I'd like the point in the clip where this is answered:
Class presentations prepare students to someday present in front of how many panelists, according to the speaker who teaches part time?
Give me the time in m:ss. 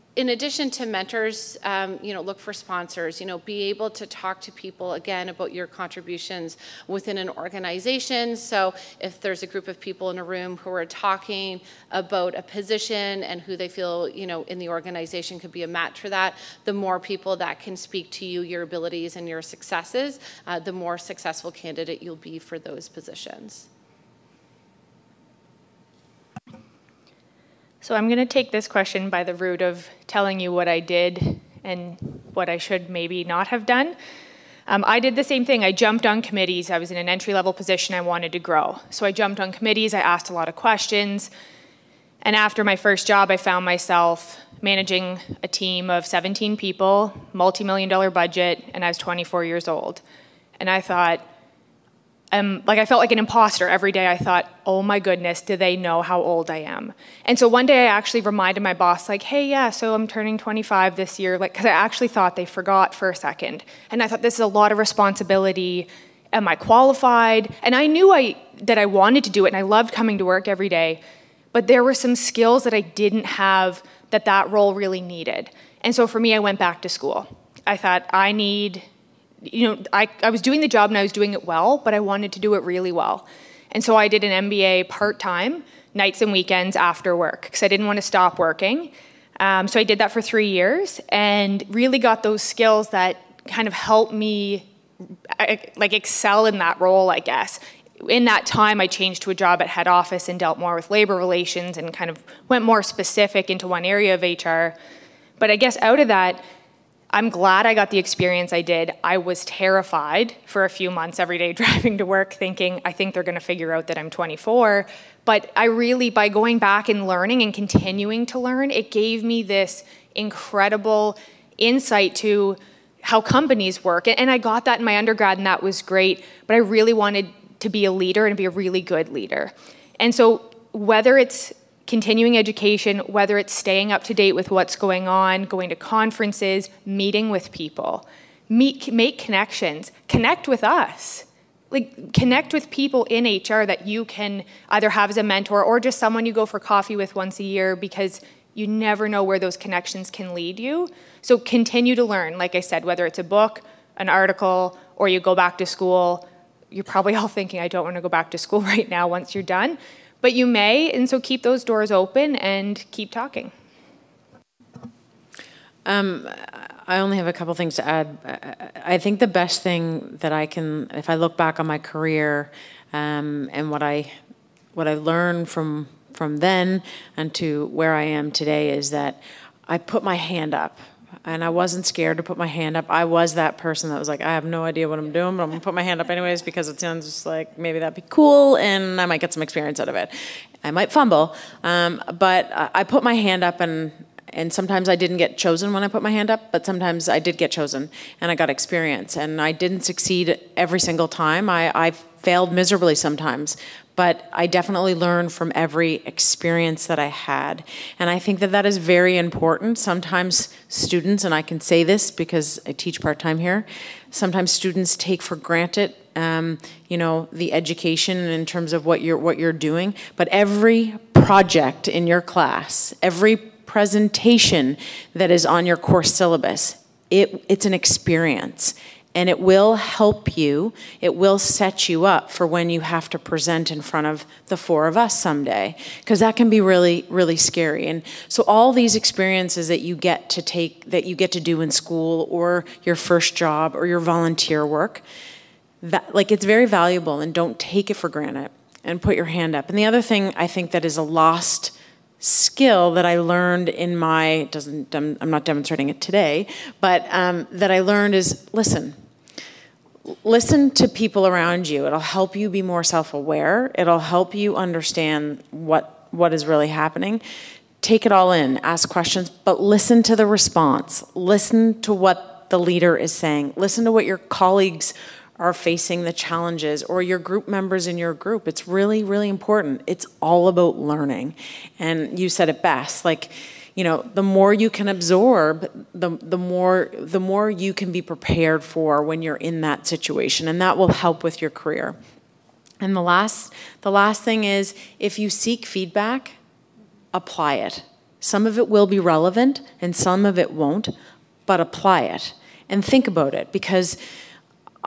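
3:54.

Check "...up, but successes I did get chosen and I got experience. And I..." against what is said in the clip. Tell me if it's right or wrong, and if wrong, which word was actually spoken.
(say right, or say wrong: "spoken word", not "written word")
wrong: "sometimes", not "successes".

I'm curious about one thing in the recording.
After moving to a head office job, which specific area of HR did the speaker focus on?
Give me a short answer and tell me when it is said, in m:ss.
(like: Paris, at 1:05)
labor relations, at 1:40.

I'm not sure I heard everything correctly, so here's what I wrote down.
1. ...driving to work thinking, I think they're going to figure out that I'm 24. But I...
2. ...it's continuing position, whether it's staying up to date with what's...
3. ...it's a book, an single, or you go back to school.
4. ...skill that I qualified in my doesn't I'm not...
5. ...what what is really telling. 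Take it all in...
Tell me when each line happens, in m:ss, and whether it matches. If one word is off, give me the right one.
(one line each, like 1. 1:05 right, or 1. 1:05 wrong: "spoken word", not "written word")
1. 1:51 right
2. 2:11 wrong: "education", not "position"
3. 2:33 wrong: "article", not "single"
4. 4:12 wrong: "learned", not "qualified"
5. 4:25 wrong: "happening", not "telling".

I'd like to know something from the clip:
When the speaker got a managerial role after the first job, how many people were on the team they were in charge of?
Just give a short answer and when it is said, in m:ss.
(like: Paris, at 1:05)
17, at 0:46.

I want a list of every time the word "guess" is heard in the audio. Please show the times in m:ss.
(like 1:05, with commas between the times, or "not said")
1:37, 1:45.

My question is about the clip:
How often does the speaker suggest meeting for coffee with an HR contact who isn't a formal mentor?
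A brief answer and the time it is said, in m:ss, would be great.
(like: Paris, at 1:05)
once a year, at 2:27.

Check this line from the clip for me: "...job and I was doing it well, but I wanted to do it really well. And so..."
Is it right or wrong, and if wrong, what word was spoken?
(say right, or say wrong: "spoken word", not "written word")
right.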